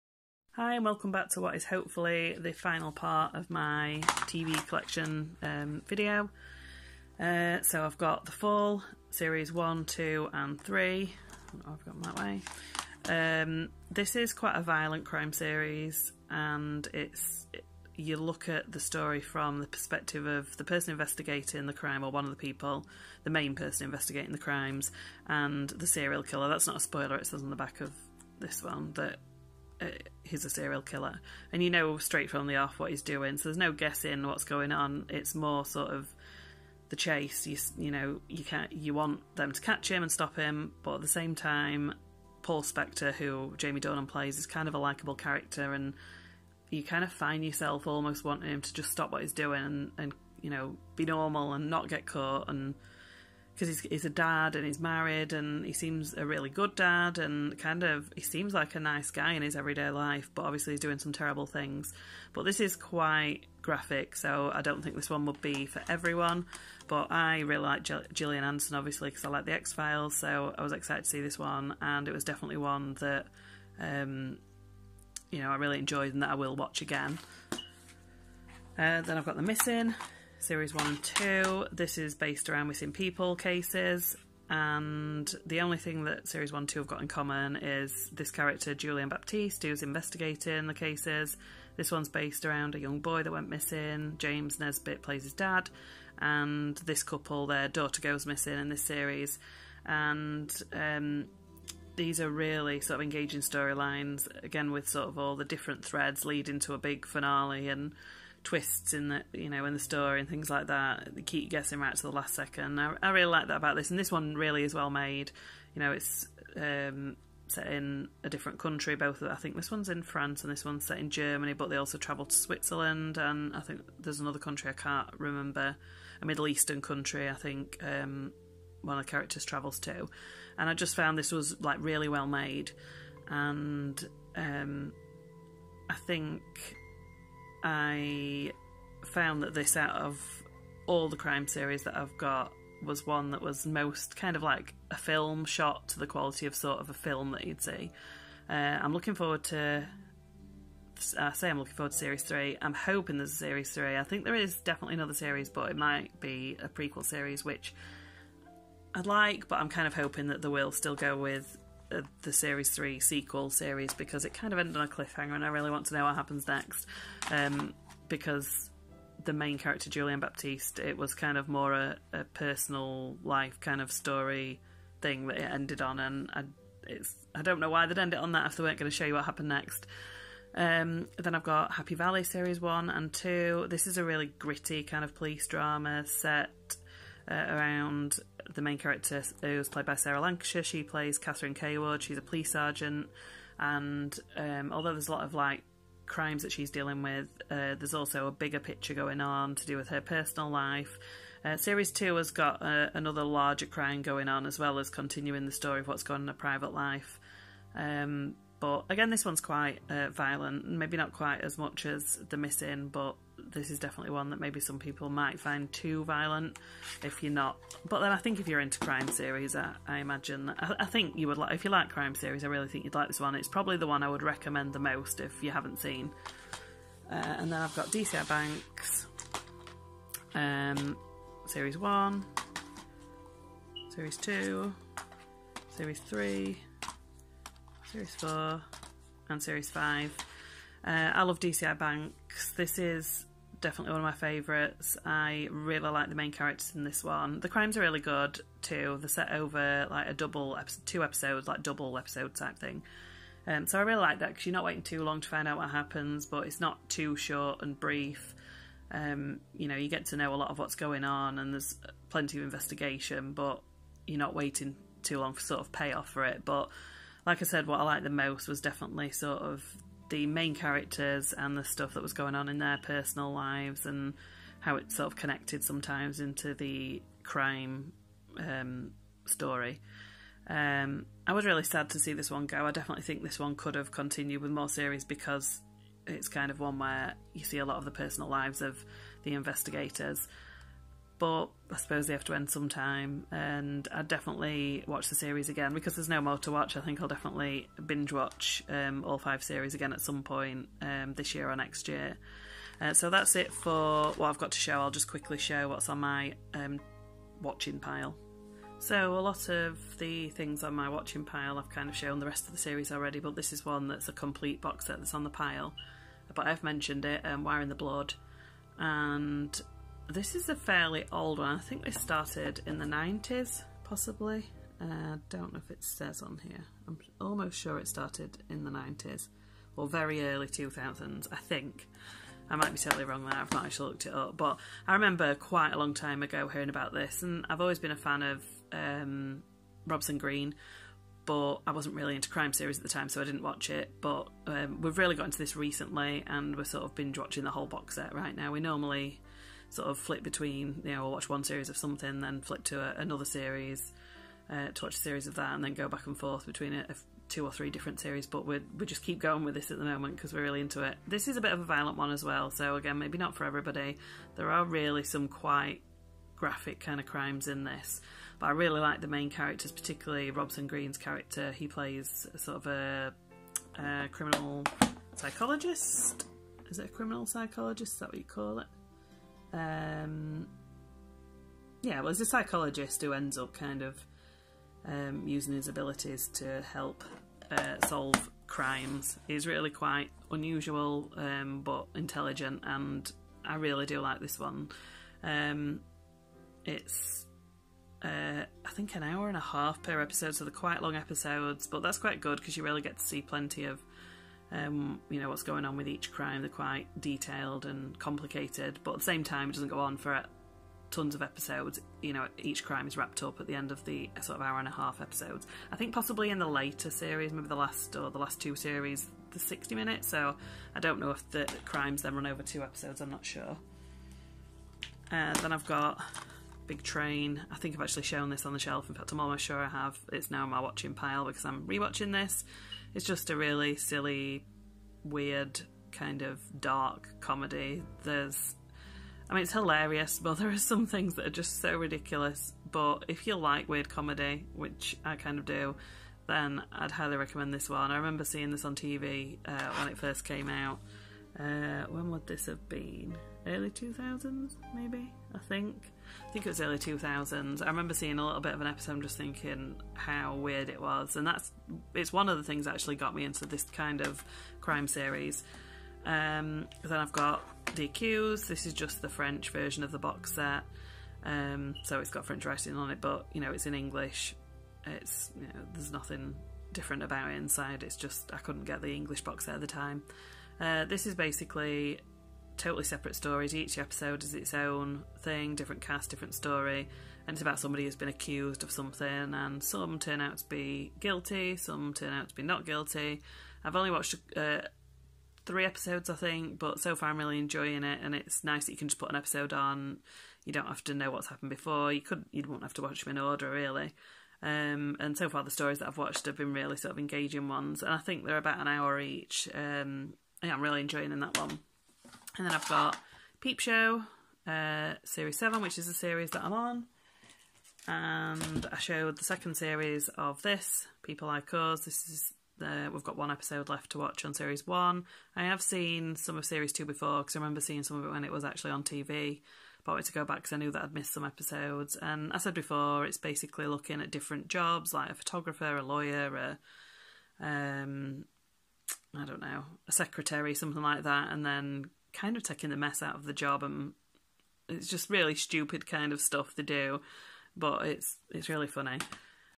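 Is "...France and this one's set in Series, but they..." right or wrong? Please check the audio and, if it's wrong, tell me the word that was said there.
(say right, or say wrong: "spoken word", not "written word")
wrong: "Germany", not "Series".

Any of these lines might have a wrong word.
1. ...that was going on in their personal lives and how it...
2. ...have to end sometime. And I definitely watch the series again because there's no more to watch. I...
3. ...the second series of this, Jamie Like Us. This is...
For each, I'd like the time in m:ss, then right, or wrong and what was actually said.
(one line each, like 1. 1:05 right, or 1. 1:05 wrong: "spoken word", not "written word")
1. 4:31 right
2. 4:52 right
3. 8:39 wrong: "People", not "Jamie".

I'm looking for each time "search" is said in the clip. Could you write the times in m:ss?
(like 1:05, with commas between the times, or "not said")
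not said.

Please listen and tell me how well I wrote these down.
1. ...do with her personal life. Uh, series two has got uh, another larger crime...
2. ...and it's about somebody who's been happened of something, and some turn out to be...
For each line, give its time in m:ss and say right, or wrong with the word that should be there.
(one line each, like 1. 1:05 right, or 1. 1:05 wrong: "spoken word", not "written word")
1. 3:19 right
2. 8:07 wrong: "accused", not "happened".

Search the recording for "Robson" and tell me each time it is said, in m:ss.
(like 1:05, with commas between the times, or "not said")
5:39, 6:10.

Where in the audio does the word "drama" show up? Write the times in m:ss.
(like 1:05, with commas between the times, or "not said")
3:05.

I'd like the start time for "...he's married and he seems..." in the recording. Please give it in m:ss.
0:54.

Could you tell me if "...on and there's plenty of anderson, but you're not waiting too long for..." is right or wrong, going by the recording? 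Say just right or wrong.
wrong.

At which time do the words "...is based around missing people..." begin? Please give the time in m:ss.
1:21.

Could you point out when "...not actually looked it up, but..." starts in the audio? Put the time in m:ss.
5:33.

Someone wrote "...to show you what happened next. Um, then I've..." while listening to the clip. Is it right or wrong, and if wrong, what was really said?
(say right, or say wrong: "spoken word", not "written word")
right.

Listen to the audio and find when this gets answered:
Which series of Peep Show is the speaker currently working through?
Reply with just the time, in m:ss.
8:35.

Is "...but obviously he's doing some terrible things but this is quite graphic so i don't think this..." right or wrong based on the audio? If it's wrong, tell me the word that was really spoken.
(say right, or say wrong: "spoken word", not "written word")
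right.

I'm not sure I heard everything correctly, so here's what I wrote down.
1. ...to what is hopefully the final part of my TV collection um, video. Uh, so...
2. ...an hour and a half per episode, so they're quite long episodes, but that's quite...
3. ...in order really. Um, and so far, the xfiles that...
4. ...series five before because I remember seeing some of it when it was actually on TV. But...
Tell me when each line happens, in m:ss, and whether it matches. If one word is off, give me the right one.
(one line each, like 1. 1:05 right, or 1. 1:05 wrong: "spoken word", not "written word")
1. 0:01 right
2. 6:38 right
3. 8:23 wrong: "stories", not "xfiles"
4. 8:46 wrong: "two", not "five".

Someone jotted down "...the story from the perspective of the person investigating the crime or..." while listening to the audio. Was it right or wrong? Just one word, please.
right.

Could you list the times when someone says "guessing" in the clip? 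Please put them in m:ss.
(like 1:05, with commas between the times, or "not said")
0:33, 1:51.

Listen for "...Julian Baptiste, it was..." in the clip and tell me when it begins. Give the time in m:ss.
2:49.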